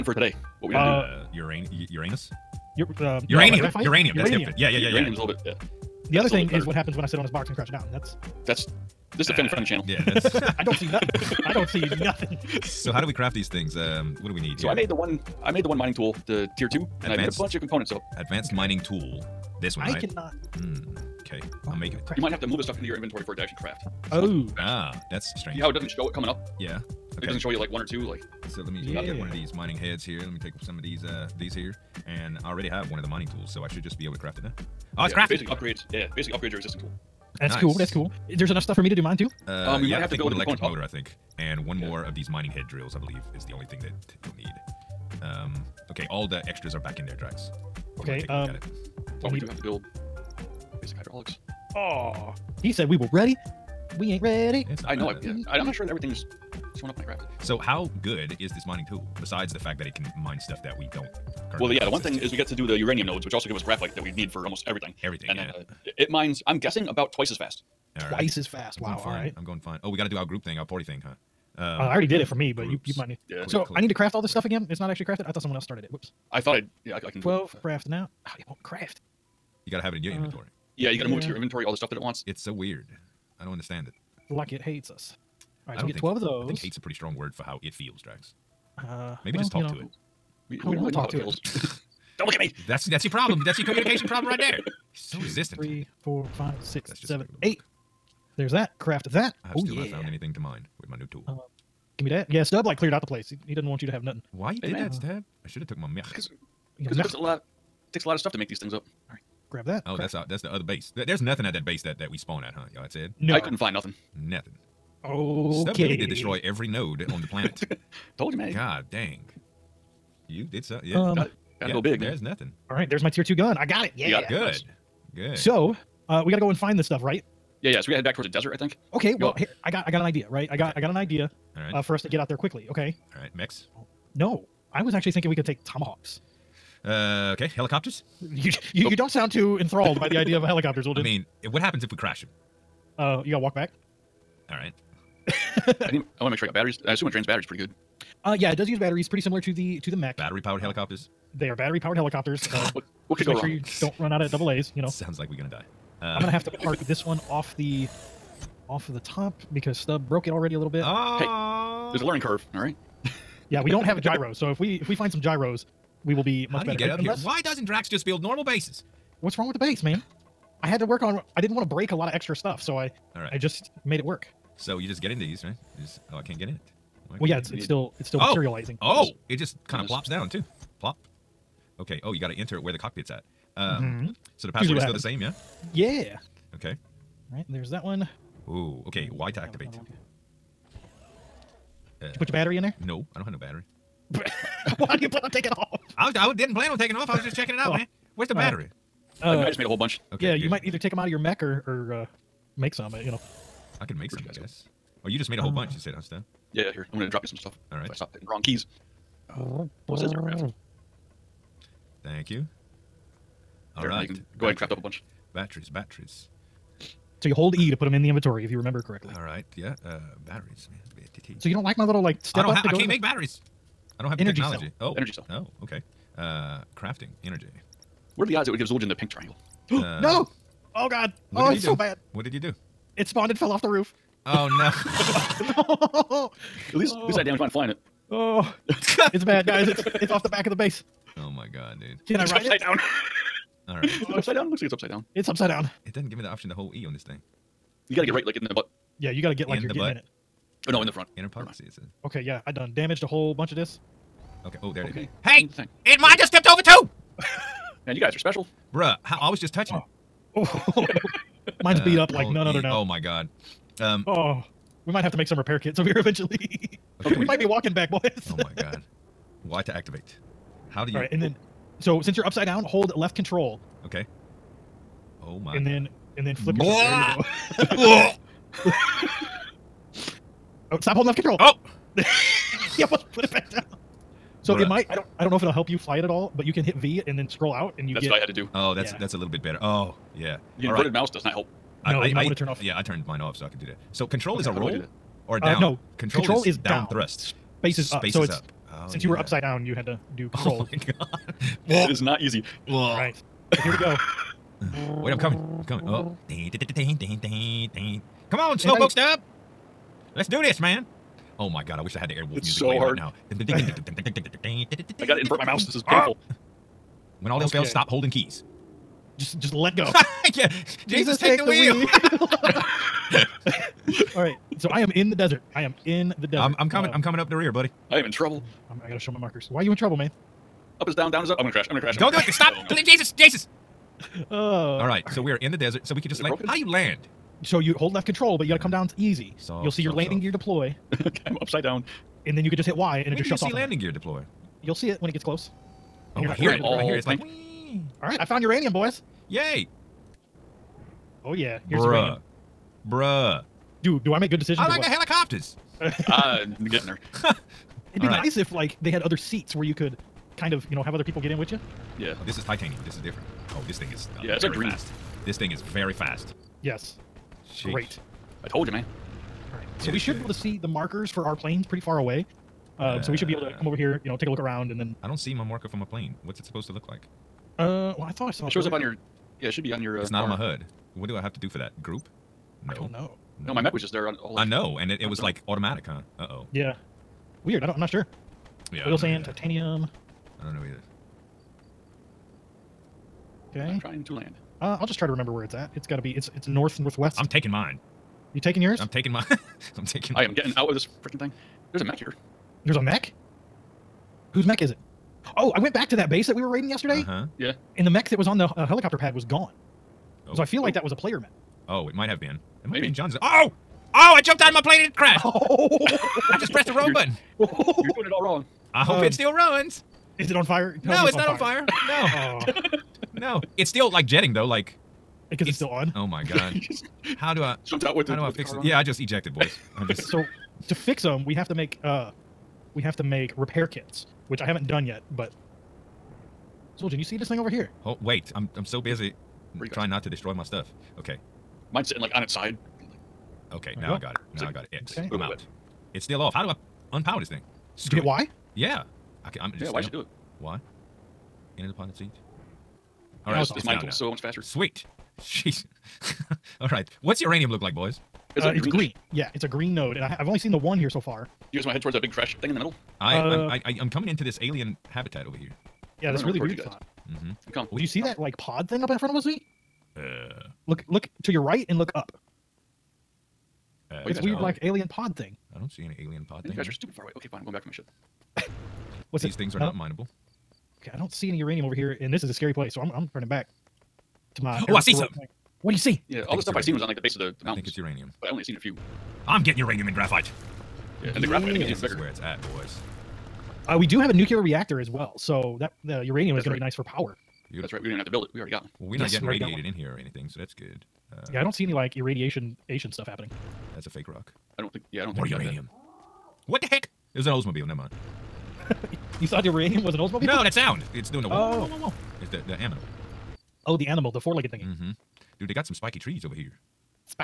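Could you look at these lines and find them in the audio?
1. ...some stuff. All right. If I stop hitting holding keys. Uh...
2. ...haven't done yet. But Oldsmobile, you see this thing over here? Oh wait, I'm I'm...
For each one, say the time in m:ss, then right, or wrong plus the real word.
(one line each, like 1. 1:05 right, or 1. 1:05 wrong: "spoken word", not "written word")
1. 3:27 wrong: "wrong", not "holding"
2. 7:14 wrong: "Zueljin", not "Oldsmobile".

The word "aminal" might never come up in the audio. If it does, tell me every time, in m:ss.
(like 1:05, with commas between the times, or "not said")
8:32.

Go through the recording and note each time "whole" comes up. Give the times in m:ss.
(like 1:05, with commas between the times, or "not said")
3:19, 3:25, 4:13.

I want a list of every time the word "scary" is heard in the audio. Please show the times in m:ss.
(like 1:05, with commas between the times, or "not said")
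8:02.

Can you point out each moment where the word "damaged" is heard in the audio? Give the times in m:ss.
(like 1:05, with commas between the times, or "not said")
3:57, 4:12.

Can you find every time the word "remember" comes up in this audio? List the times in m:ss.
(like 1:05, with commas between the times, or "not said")
3:38, 6:35.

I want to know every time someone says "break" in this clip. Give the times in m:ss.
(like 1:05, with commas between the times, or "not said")
2:51.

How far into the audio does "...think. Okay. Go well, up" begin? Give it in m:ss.
2:08.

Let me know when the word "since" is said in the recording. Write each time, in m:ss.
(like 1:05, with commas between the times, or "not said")
4:32, 4:58.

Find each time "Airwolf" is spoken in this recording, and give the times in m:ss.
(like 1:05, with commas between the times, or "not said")
5:12.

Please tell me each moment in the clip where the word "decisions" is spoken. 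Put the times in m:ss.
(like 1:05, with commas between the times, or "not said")
5:54.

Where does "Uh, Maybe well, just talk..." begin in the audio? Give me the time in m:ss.
1:28.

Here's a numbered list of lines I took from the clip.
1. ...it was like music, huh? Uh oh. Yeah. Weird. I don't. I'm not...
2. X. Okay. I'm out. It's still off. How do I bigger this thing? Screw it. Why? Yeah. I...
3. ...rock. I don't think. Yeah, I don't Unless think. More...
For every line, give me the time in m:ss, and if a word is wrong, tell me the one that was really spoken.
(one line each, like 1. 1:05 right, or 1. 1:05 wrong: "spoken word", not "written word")
1. 6:25 wrong: "automatic", not "music"
2. 7:24 wrong: "unpower", not "bigger"
3. 8:24 wrong: "More", not "Unless".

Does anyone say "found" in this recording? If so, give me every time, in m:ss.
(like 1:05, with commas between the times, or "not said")
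1:39, 5:48.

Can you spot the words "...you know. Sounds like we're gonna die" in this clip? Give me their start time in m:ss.
2:34.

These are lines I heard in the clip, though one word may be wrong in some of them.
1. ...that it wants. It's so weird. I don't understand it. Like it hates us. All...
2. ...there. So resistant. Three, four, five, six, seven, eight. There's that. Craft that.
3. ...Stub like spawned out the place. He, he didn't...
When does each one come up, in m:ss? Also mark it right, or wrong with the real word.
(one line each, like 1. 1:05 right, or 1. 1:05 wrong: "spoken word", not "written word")
1. 1:21 right
2. 1:34 right
3. 1:42 wrong: "cleared", not "spawned".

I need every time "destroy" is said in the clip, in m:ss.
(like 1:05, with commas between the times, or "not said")
1:56, 7:20.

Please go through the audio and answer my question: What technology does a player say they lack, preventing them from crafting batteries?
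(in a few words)
energy technology.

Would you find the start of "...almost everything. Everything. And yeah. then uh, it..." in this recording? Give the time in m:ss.
1:04.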